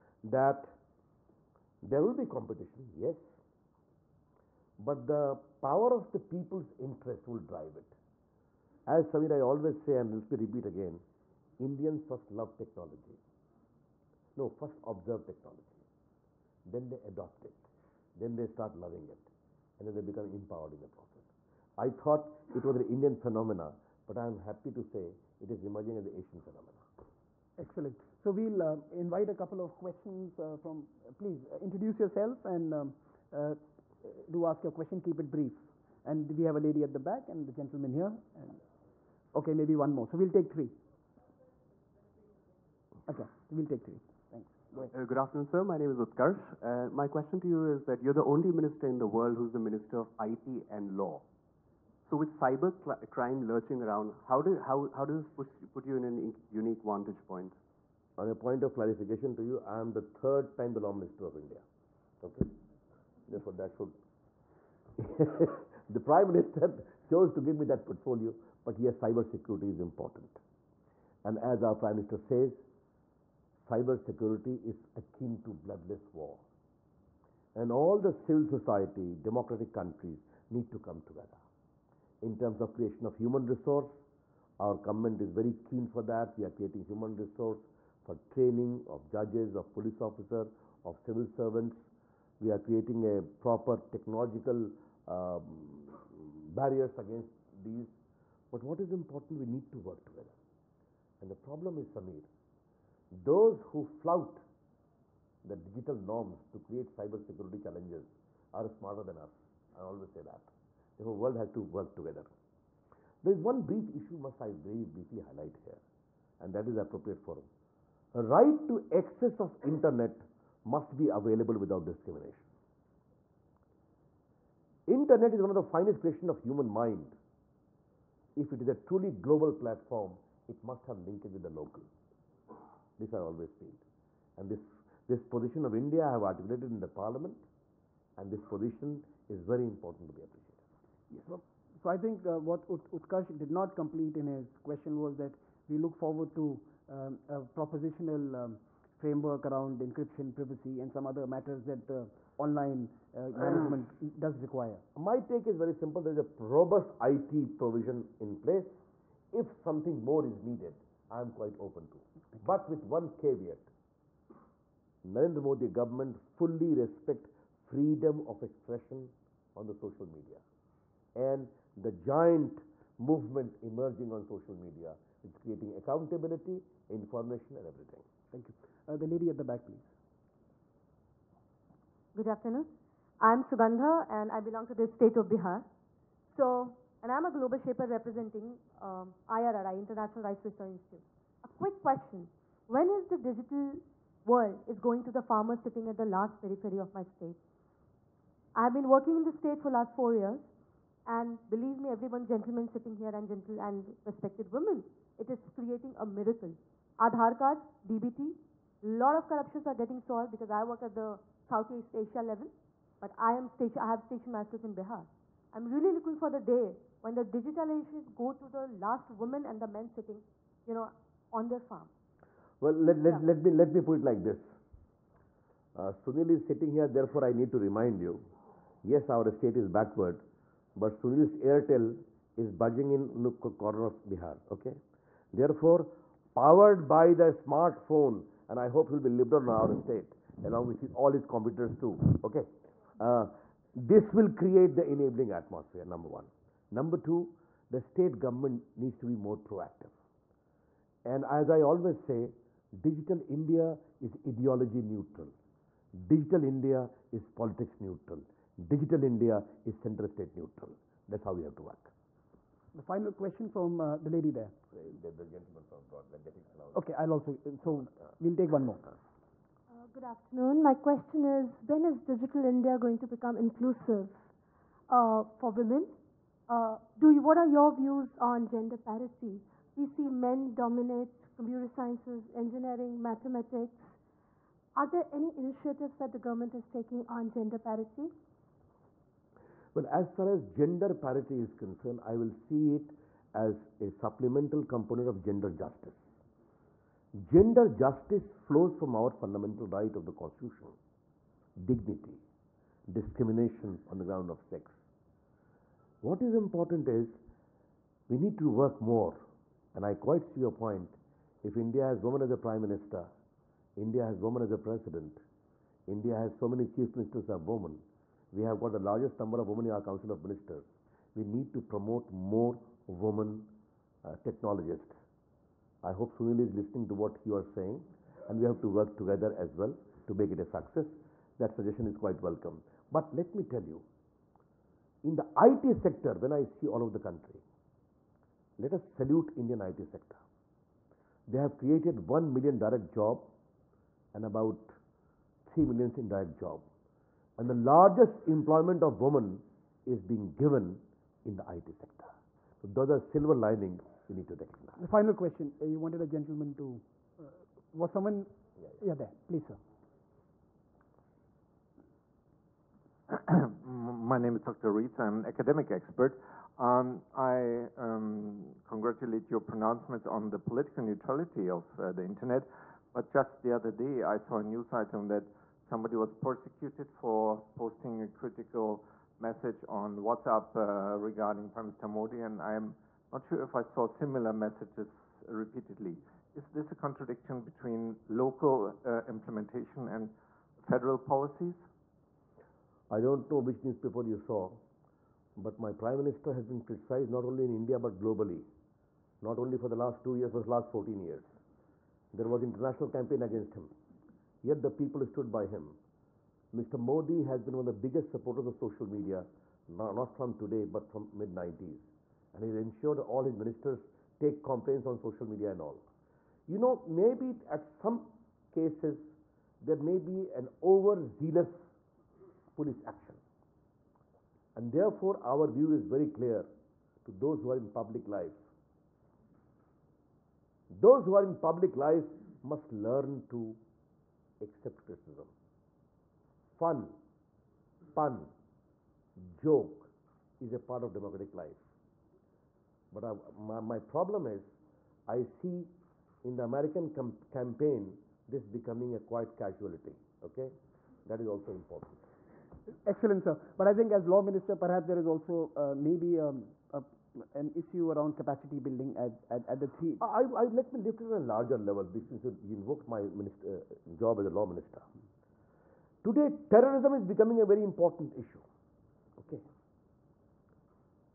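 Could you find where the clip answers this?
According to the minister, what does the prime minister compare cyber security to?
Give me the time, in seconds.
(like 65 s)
75 s.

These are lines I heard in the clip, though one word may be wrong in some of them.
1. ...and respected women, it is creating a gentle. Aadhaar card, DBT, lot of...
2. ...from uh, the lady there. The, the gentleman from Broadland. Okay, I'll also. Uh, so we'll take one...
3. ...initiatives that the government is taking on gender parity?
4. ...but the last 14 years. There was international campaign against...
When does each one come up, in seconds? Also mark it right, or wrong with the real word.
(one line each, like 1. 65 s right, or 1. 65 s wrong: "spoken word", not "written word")
1. 203 s wrong: "miracle", not "gentle"
2. 263 s right
3. 285 s right
4. 400 s right.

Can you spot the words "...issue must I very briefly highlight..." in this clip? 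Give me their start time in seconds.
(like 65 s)
113 s.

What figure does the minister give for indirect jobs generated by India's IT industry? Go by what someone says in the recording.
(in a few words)
3 million.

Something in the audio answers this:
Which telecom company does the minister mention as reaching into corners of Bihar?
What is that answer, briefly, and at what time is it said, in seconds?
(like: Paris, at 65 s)
Airtel, at 231 s.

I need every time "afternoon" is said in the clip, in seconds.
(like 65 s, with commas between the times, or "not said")
45 s, 182 s, 270 s.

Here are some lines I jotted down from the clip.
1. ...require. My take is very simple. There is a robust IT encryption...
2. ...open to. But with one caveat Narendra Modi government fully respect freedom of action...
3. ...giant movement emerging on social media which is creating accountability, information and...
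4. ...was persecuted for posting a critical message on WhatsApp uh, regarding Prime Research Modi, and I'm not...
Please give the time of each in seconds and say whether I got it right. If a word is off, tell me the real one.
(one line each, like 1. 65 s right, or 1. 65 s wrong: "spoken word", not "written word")
1. 154 s wrong: "provision", not "encryption"
2. 161 s wrong: "expression", not "action"
3. 171 s right
4. 375 s wrong: "Minister", not "Research".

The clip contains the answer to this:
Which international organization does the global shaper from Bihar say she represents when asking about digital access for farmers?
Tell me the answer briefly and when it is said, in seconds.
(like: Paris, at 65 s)
International Rice Research Institute, at 189 s.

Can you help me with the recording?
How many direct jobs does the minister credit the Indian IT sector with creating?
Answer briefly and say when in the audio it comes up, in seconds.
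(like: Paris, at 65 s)
1 million, at 342 s.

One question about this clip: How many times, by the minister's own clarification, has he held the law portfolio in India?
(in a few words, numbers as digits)
3.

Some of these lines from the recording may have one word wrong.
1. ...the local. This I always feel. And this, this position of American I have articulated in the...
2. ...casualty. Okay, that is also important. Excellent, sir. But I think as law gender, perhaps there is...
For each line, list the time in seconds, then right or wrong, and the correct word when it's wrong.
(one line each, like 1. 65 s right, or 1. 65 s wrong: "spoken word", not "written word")
1. 131 s wrong: "India", not "American"
2. 449 s wrong: "minister", not "gender".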